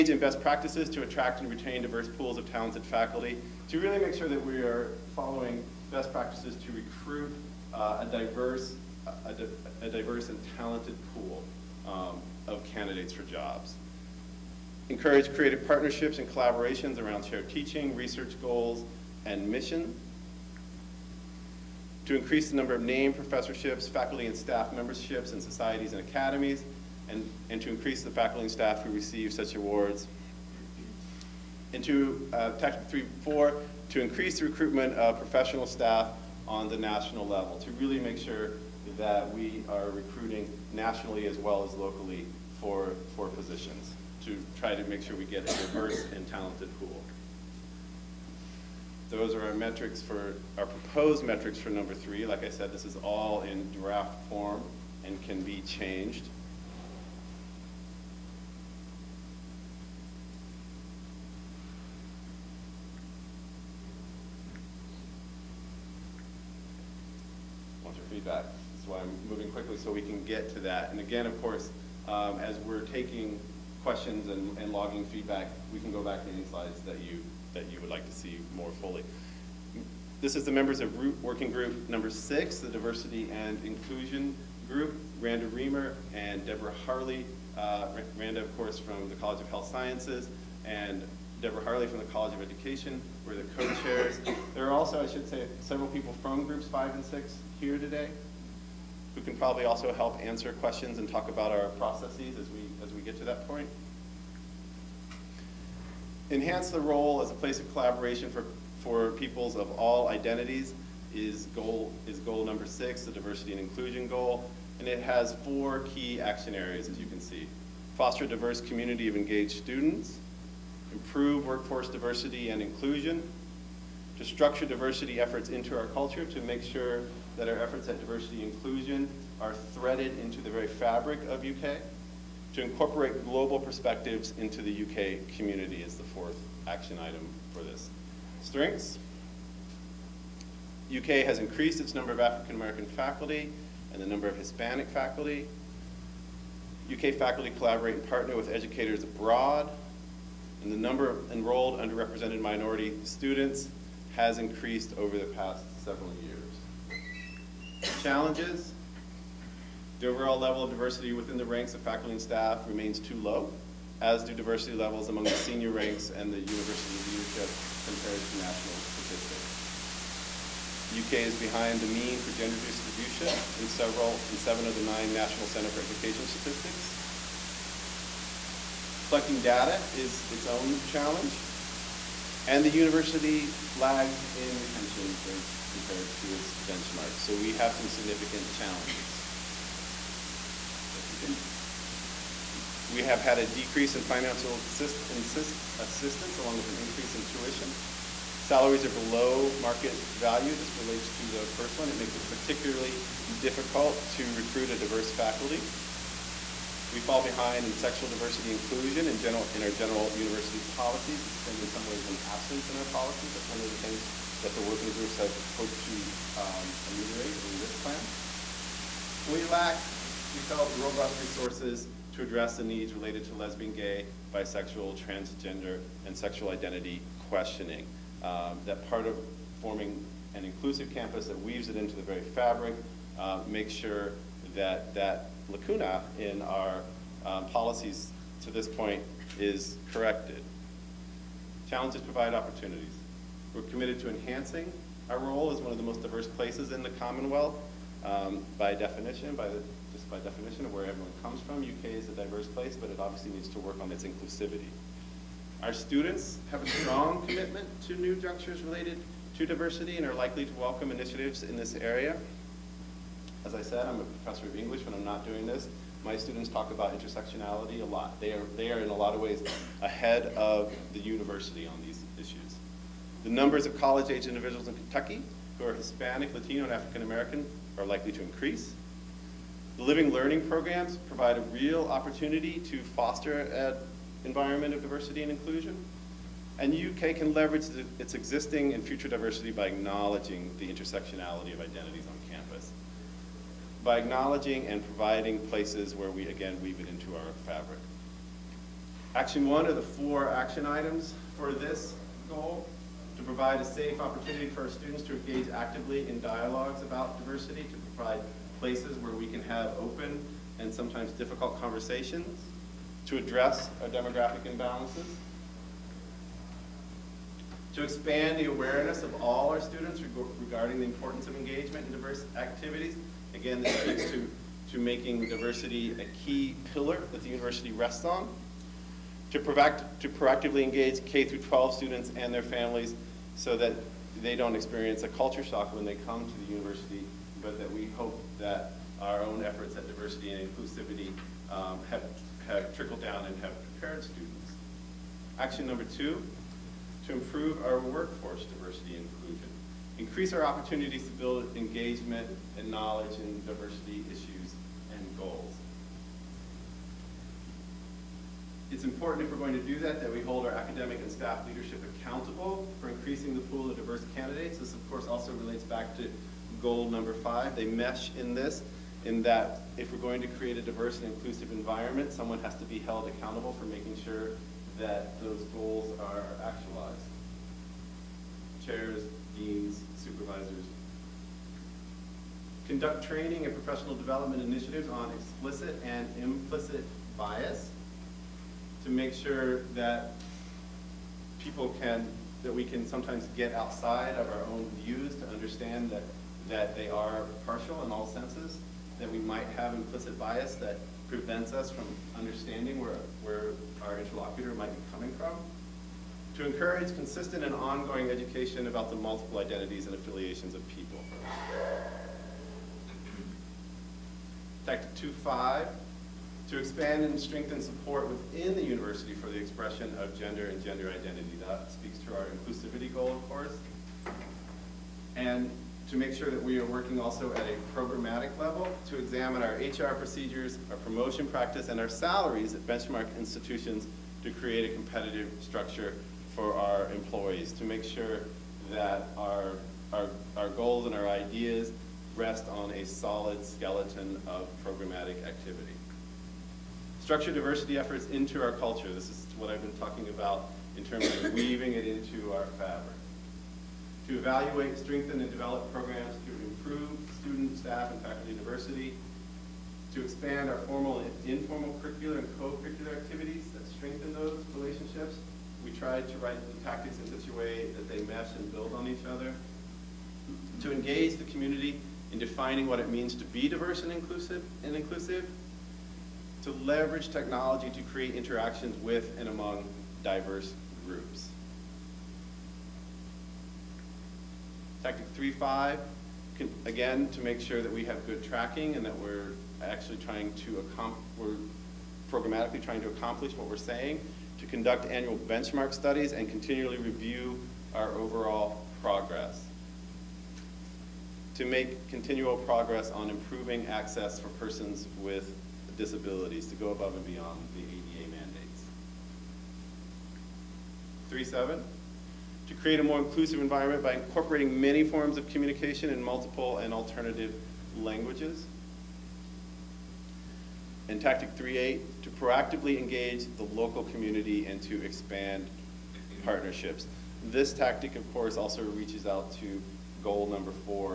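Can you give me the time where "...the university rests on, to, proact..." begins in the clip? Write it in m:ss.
5:27.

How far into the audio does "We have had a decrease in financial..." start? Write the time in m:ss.
3:12.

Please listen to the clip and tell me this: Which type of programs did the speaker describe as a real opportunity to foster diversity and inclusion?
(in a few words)
Living learning programs.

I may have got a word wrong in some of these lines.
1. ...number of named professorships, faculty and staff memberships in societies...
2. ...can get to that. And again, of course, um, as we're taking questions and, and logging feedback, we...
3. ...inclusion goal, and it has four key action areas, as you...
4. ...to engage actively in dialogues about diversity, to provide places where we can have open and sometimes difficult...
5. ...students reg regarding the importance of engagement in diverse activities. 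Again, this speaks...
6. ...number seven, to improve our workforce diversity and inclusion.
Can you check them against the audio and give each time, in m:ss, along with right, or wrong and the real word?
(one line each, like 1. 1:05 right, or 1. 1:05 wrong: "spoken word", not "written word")
1. 0:22 right
2. 1:10 right
3. 1:53 right
4. 5:05 right
5. 5:19 right
6. 5:45 wrong: "two", not "seven".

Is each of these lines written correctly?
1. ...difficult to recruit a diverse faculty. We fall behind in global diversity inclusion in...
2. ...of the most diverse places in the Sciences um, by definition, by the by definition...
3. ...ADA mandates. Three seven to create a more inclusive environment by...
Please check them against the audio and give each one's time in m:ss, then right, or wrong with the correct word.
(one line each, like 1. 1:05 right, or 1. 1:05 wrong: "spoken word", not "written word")
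1. 3:23 wrong: "sexual", not "global"
2. 4:05 wrong: "Commonwealth", not "Sciences"
3. 8:27 right.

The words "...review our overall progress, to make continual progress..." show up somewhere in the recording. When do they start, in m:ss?
8:16.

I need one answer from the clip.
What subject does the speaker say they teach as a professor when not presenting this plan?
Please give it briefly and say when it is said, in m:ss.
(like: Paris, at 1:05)
English, at 4:24.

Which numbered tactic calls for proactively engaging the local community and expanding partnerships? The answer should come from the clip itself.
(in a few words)
3.8.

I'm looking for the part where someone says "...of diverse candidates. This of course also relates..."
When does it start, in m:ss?
6:03.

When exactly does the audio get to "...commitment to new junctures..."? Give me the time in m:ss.
4:17.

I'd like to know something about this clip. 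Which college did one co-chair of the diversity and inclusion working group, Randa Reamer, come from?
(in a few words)
College of Health Sciences.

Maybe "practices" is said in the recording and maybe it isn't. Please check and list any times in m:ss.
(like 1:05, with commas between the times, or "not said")
0:00, 0:06, 7:11.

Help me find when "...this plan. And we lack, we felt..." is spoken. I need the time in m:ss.
3:37.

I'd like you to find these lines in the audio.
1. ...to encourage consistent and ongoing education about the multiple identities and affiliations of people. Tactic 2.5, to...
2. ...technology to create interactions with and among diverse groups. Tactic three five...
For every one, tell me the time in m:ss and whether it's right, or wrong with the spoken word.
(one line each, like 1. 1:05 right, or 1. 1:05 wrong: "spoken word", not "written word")
1. 6:46 right
2. 7:57 right.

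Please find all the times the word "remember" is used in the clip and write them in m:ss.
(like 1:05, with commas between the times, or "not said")
not said.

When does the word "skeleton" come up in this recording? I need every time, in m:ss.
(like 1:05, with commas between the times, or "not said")
7:23.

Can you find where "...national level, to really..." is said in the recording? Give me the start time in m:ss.
0:36.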